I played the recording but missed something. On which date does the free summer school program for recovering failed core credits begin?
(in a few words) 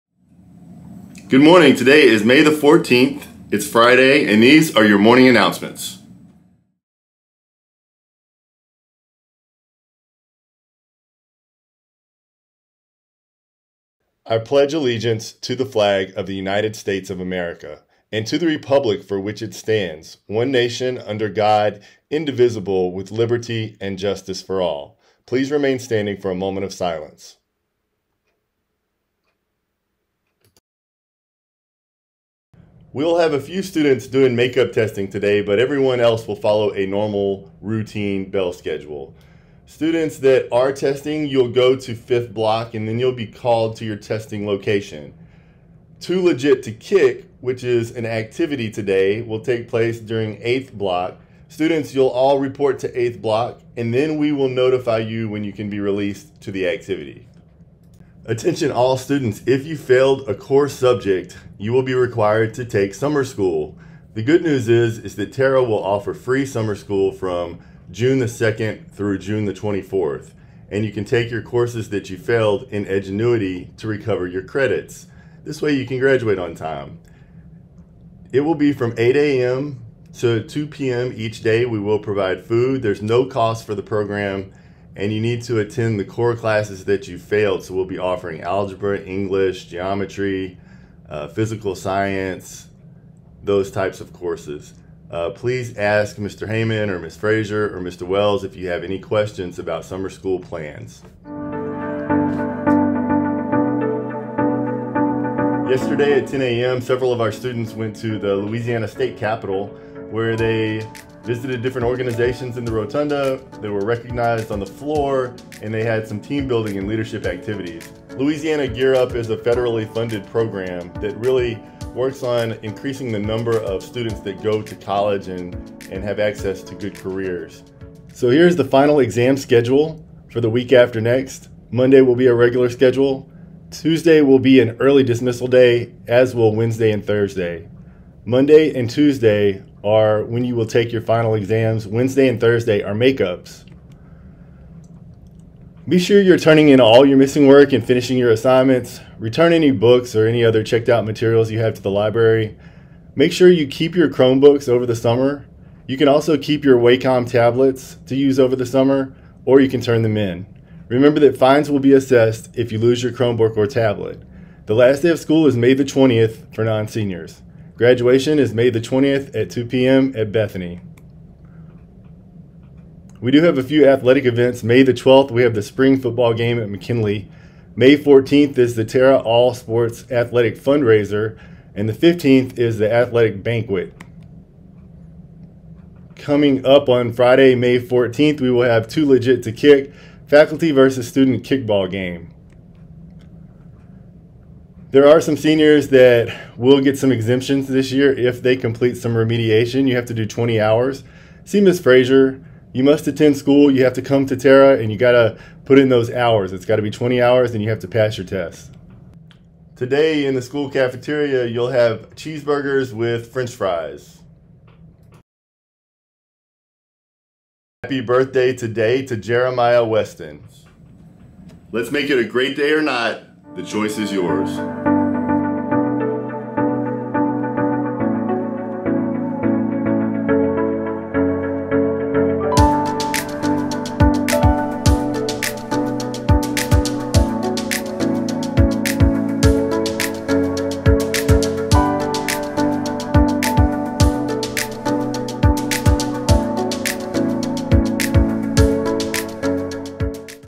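June 2nd.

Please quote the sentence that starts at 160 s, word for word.
Remember that fines will be assessed if you lose your Chromebook or tablet.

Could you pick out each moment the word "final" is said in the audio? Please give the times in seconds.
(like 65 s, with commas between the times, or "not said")
128 s, 141 s.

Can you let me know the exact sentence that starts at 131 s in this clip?
Monday will be a regular schedule.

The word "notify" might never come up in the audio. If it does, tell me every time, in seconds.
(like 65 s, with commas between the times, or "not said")
54 s.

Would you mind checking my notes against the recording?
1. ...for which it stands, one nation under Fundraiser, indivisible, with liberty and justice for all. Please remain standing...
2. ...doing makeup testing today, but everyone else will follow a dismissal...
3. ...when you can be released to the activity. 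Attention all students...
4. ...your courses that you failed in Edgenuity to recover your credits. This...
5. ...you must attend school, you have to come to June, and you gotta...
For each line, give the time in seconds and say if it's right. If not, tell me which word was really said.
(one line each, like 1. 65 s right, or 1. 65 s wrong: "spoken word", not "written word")
1. 19 s wrong: "God", not "Fundraiser"
2. 34 s wrong: "normal", not "dismissal"
3. 55 s right
4. 71 s right
5. 202 s wrong: "Tara", not "June".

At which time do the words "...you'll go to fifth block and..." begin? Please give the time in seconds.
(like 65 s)
41 s.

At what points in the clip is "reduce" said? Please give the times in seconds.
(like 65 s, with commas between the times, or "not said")
not said.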